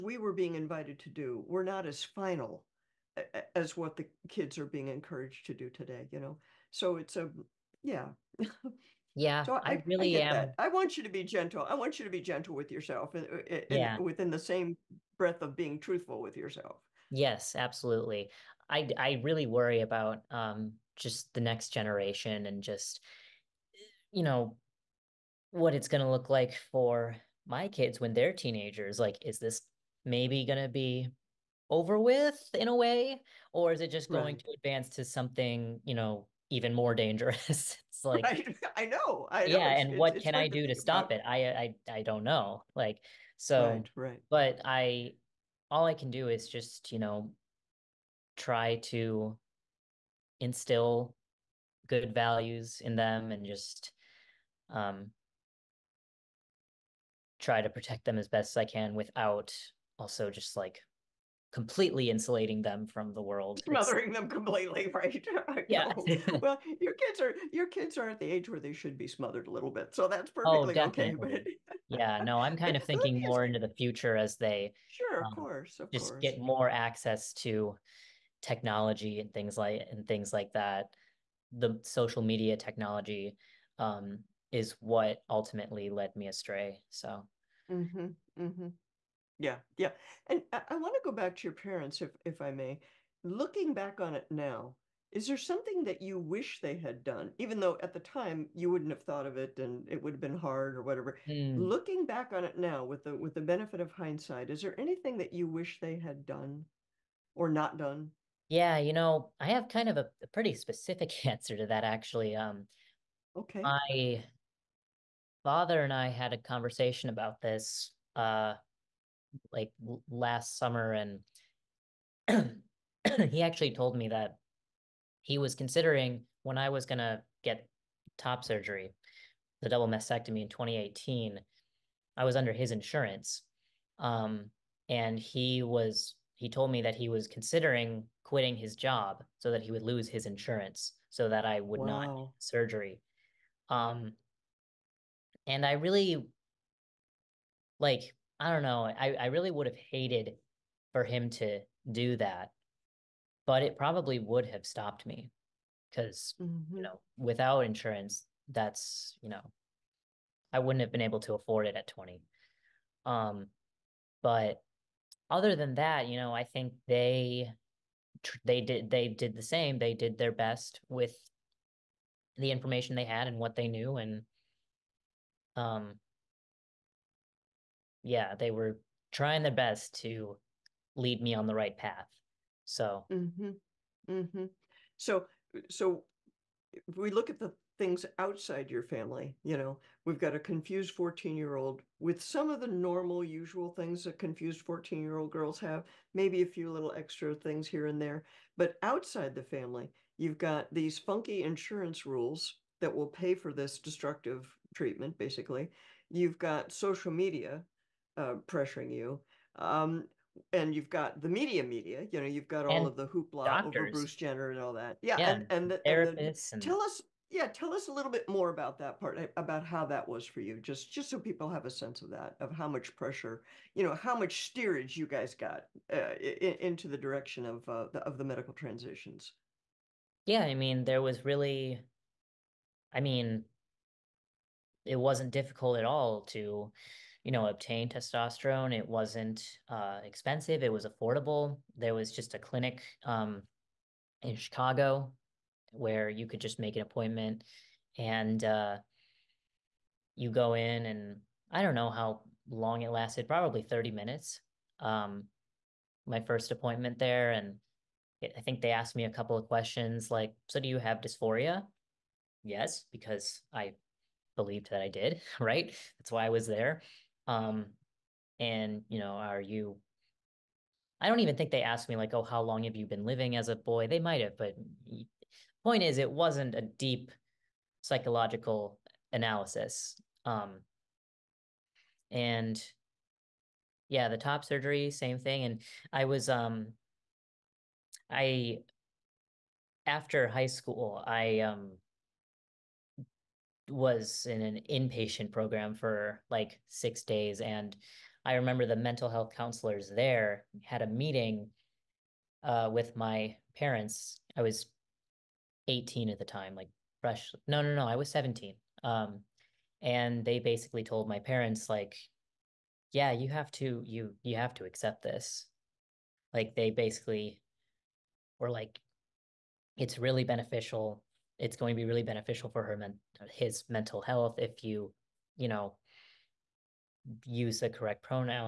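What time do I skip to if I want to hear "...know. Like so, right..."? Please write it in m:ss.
0:42.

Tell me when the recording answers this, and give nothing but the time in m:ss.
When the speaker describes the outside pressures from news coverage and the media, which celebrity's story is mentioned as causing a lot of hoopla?
3:33.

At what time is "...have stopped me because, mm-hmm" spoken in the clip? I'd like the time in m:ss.
2:34.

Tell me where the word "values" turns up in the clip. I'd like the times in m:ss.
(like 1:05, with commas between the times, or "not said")
0:52.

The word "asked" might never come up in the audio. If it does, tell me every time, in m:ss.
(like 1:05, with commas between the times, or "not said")
4:18, 4:31.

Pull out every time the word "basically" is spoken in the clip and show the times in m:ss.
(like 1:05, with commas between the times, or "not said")
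3:25, 5:10, 5:16.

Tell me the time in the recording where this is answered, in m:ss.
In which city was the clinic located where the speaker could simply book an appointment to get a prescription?
4:04.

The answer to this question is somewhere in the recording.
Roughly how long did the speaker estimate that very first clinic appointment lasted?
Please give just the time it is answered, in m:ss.
4:13.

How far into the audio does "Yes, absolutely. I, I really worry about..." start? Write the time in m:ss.
0:17.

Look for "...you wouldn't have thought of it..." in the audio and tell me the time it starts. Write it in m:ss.
1:38.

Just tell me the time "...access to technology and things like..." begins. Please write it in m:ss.
1:16.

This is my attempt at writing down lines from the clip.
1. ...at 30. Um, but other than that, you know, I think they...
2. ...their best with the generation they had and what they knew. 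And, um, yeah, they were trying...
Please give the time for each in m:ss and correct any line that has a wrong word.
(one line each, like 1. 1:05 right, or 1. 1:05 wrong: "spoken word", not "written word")
1. 2:41 wrong: "20", not "30"
2. 2:50 wrong: "information", not "generation".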